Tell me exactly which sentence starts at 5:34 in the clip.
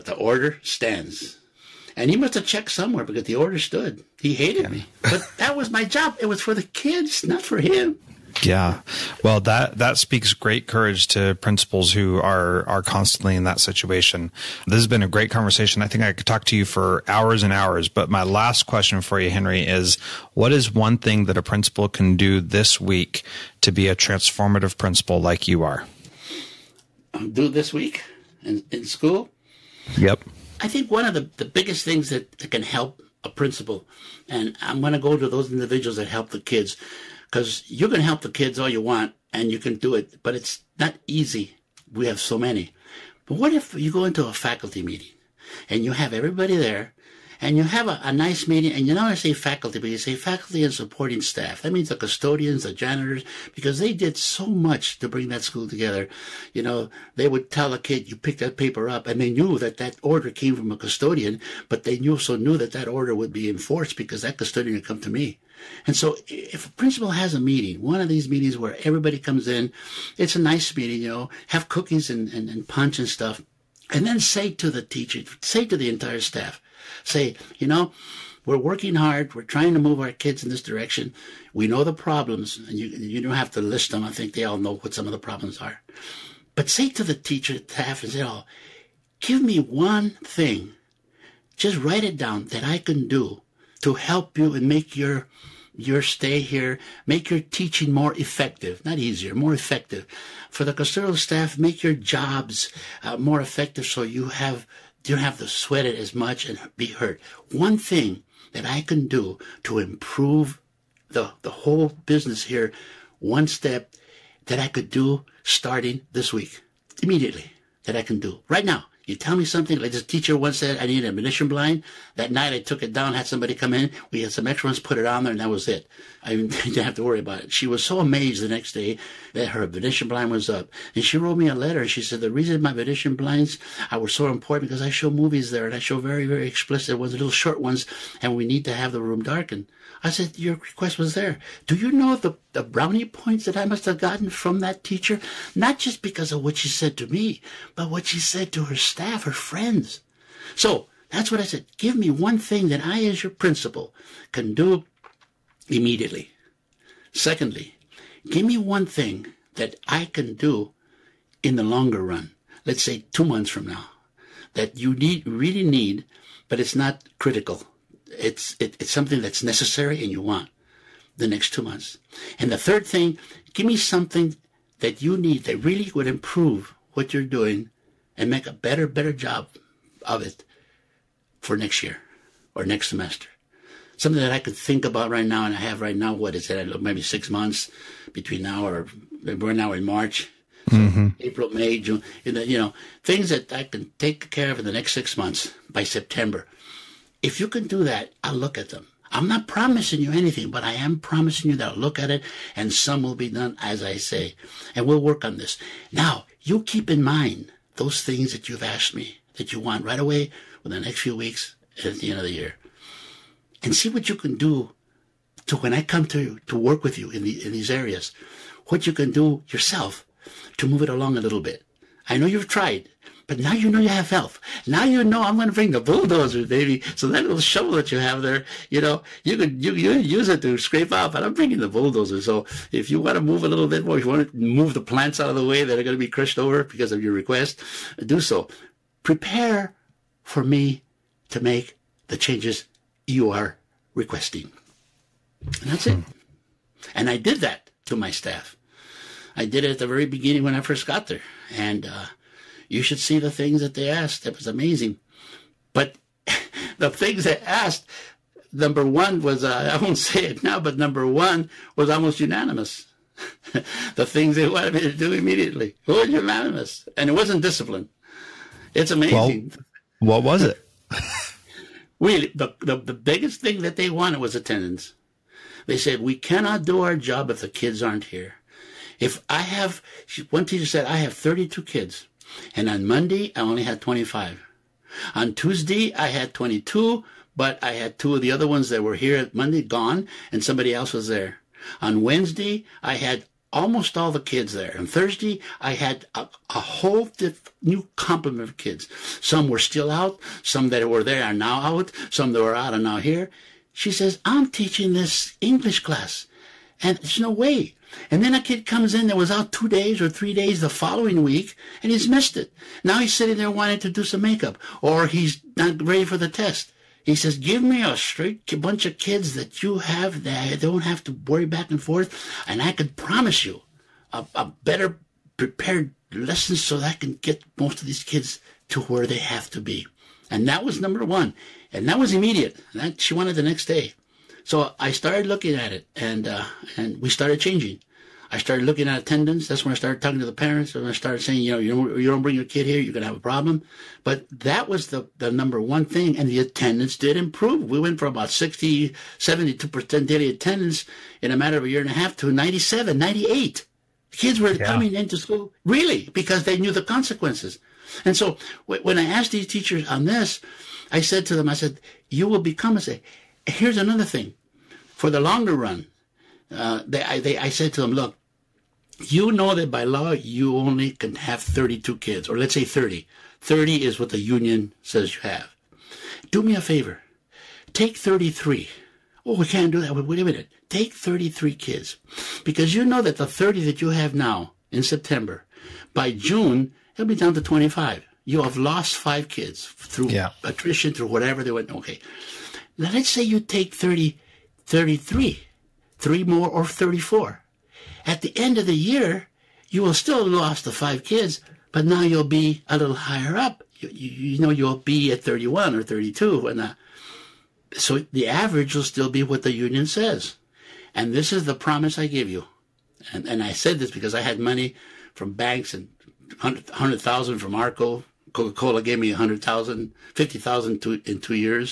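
So I started looking at it, and uh, and we started changing.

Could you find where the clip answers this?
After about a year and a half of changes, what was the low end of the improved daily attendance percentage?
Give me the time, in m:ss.
5:52.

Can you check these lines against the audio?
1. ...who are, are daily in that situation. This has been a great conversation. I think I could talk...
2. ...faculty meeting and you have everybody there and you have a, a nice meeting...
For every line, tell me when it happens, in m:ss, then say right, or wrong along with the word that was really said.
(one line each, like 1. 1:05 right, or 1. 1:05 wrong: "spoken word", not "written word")
1. 0:11 wrong: "constantly", not "daily"
2. 0:44 right.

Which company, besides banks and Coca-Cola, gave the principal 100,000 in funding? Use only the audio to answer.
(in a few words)
Arco.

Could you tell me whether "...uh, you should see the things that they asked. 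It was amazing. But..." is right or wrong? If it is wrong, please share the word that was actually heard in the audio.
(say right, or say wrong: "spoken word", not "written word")
right.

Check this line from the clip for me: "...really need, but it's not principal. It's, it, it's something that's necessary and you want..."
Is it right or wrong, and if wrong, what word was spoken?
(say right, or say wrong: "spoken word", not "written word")
wrong: "critical", not "principal".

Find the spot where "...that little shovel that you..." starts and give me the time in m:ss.
3:47.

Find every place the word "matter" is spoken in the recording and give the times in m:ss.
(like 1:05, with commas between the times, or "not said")
5:51.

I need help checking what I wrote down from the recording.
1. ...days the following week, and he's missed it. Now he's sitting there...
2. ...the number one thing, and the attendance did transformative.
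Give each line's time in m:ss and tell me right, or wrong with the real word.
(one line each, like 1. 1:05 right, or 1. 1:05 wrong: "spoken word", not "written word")
1. 5:10 right
2. 5:45 wrong: "improve", not "transformative".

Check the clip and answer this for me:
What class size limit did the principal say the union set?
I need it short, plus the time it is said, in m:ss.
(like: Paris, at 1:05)
30, at 6:13.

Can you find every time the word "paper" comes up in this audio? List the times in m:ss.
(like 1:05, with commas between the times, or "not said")
0:58.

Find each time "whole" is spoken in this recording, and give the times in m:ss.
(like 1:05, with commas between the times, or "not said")
1:51, 4:56.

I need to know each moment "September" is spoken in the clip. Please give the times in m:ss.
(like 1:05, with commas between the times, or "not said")
3:15, 6:24.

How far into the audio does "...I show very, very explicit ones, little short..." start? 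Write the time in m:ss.
2:15.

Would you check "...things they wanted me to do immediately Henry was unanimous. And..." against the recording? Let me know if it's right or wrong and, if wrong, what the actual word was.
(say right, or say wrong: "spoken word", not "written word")
wrong: "Who", not "Henry".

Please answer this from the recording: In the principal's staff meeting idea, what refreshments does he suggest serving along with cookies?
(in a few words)
punch.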